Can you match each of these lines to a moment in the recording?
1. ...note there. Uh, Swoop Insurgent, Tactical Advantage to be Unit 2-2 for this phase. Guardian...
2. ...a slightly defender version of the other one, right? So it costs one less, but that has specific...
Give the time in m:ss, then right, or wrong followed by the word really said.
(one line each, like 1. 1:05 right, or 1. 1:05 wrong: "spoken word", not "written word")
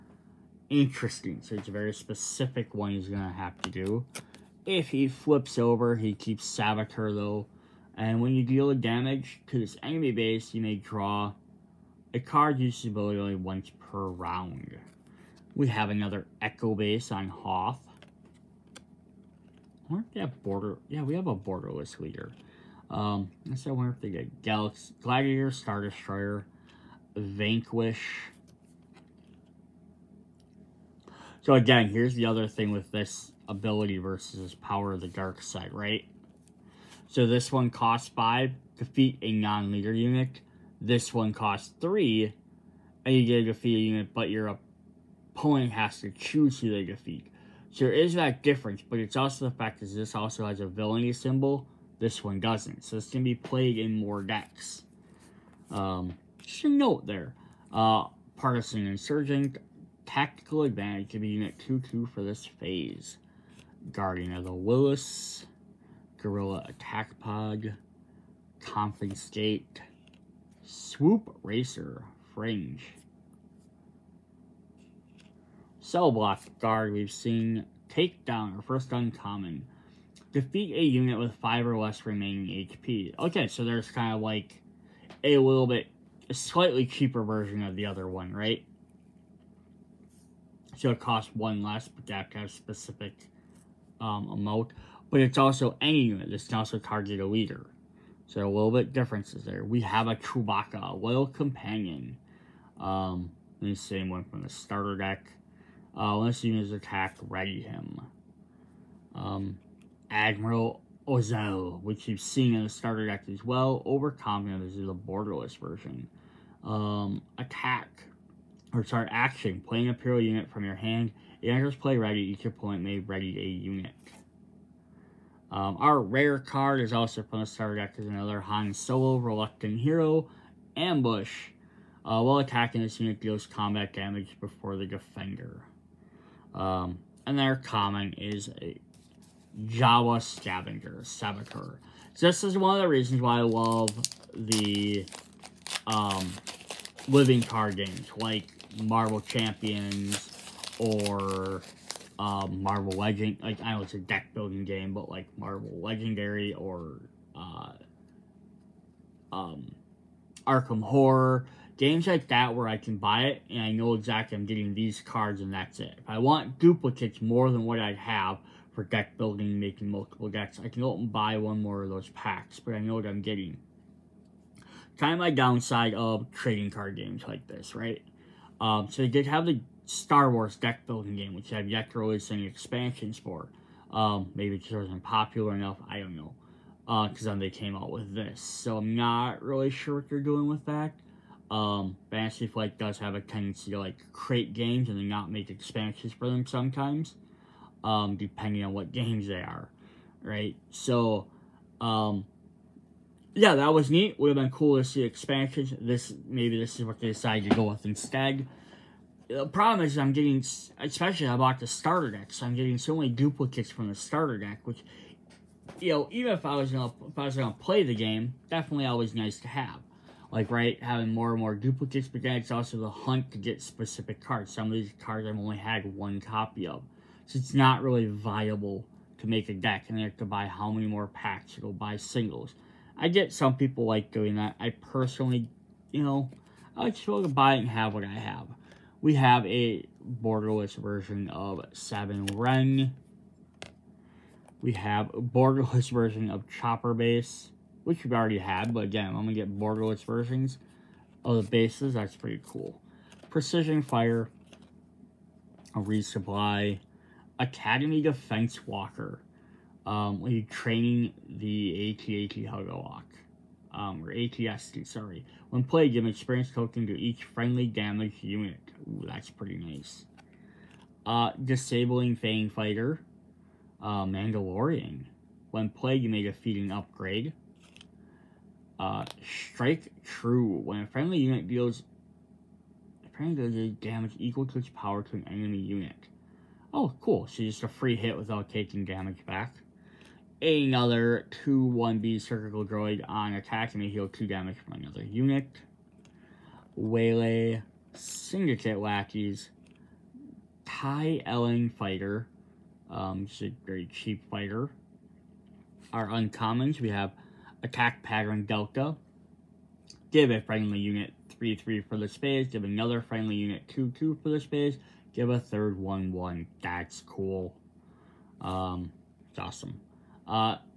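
1. 0:56 wrong: "Partisan", not "Swoop"
2. 1:26 wrong: "cheaper", not "defender".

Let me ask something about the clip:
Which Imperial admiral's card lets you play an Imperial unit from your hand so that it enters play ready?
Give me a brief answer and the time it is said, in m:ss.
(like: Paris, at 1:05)
Admiral Ozzel, at 1:50.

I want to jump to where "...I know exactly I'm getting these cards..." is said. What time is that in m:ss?
2:43.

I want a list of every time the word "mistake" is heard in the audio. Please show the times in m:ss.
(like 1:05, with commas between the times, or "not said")
not said.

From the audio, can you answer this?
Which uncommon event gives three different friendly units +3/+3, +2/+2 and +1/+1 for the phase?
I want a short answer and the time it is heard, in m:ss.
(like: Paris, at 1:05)
Attack Pattern Delta, at 5:07.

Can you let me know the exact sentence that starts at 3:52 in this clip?
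I get some people like doing that.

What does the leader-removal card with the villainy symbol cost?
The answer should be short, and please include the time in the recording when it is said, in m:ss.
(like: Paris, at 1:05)
5, at 0:37.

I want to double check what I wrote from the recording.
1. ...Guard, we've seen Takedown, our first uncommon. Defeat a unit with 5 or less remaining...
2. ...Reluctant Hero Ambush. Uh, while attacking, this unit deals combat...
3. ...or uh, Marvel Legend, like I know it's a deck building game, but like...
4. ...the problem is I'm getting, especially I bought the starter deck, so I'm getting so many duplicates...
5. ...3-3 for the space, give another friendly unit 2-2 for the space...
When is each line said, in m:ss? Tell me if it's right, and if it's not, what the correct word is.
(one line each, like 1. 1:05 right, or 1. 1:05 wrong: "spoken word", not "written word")
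1. 1:16 right
2. 2:09 right
3. 2:30 right
4. 3:29 right
5. 5:11 right.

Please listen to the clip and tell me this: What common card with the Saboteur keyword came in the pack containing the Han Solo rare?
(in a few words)
Jawa Scavenger.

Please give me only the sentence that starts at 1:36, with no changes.
This can also target a leader.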